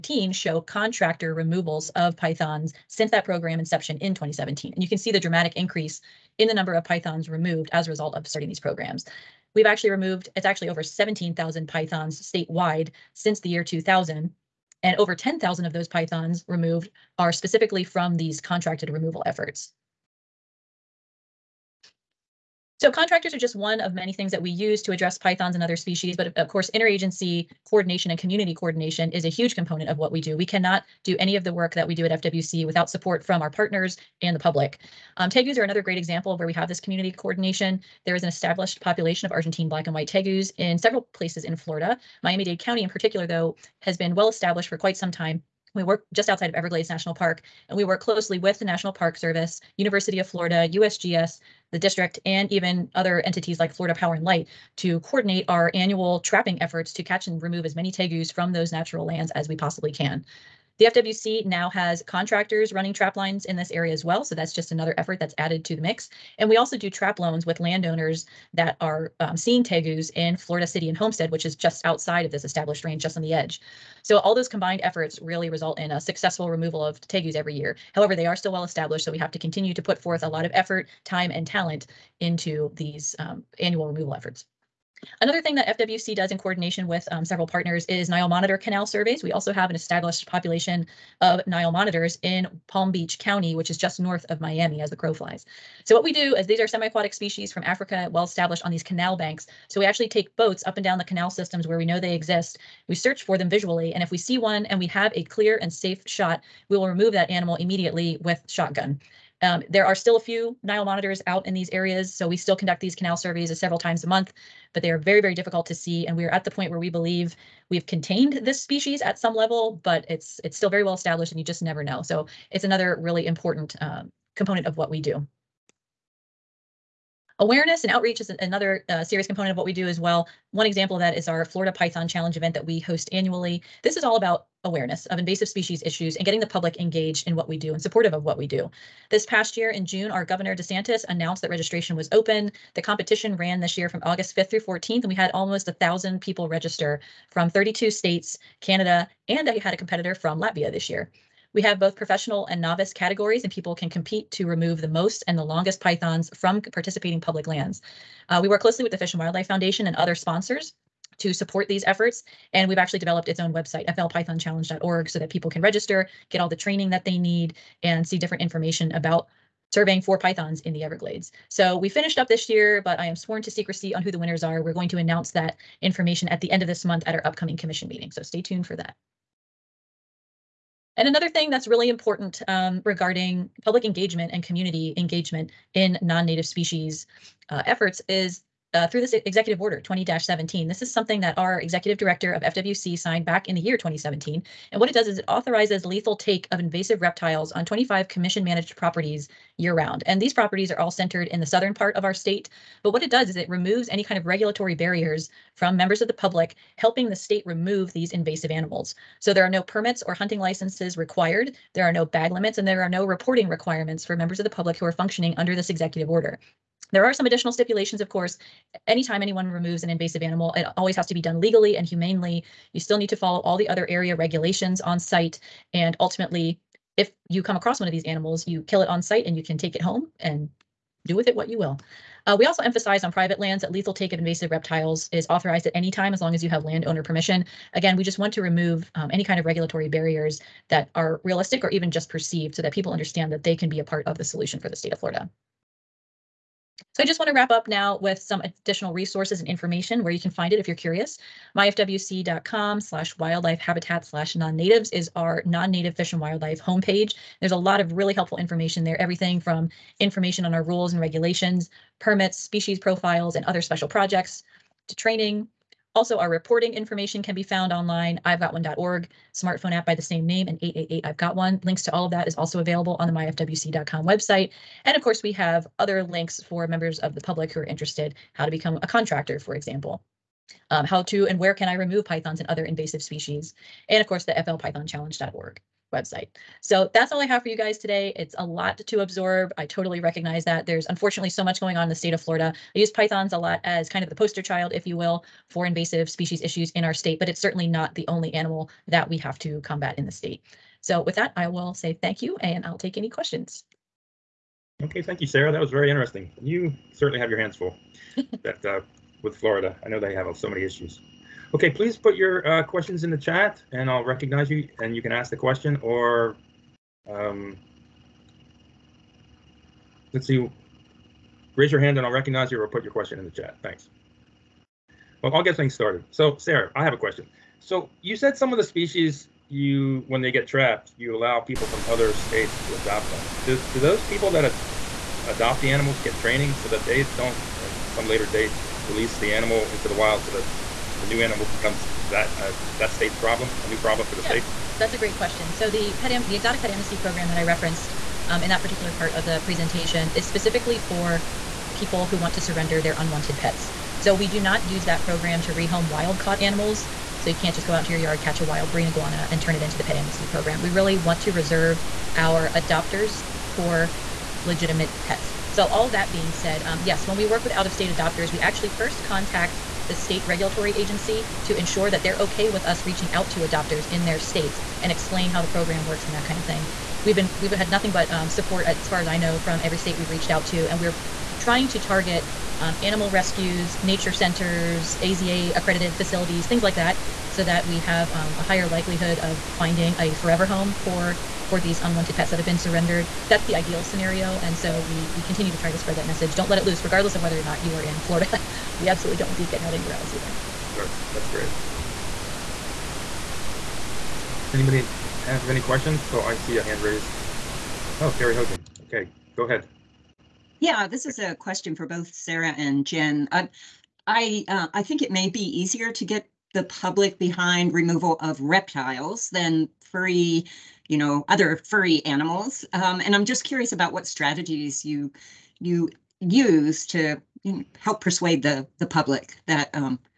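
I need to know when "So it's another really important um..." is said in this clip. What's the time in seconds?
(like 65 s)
122 s.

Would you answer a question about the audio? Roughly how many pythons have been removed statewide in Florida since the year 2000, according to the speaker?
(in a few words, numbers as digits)
17,000.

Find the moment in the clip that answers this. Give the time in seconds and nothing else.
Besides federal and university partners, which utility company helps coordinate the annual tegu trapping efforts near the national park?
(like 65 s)
53 s.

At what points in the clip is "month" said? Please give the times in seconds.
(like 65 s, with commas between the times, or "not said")
114 s, 176 s.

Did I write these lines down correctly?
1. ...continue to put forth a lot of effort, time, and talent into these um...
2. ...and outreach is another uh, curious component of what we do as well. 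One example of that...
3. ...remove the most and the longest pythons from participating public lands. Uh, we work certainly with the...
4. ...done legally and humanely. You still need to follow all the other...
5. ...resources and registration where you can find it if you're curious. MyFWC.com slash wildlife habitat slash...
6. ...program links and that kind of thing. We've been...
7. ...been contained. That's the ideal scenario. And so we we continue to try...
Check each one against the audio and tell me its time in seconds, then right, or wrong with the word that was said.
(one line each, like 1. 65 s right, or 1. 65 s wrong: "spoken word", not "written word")
1. 79 s right
2. 127 s wrong: "serious", not "curious"
3. 154 s wrong: "closely", not "certainly"
4. 221 s right
5. 248 s wrong: "information", not "registration"
6. 375 s wrong: "works", not "links"
7. 392 s wrong: "surrendered", not "contained".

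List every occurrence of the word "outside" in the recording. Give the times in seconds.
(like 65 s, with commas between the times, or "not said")
46 s, 71 s.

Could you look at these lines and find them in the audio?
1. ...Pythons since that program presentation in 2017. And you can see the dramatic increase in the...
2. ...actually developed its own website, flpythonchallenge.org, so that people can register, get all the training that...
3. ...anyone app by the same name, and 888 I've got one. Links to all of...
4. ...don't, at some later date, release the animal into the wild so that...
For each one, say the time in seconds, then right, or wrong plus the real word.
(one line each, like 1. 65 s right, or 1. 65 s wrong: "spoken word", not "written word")
1. 2 s wrong: "inception", not "presentation"
2. 162 s right
3. 269 s wrong: "smartphone", not "anyone"
4. 337 s right.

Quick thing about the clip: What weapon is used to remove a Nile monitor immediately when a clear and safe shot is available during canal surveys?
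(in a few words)
Shotgun.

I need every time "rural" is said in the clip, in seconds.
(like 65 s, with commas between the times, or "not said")
not said.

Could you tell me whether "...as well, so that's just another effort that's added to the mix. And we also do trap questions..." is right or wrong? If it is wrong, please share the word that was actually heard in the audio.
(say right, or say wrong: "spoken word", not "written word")
wrong: "loans", not "questions".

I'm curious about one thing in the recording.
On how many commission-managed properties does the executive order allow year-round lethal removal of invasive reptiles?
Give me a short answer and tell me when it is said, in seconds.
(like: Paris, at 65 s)
25, at 197 s.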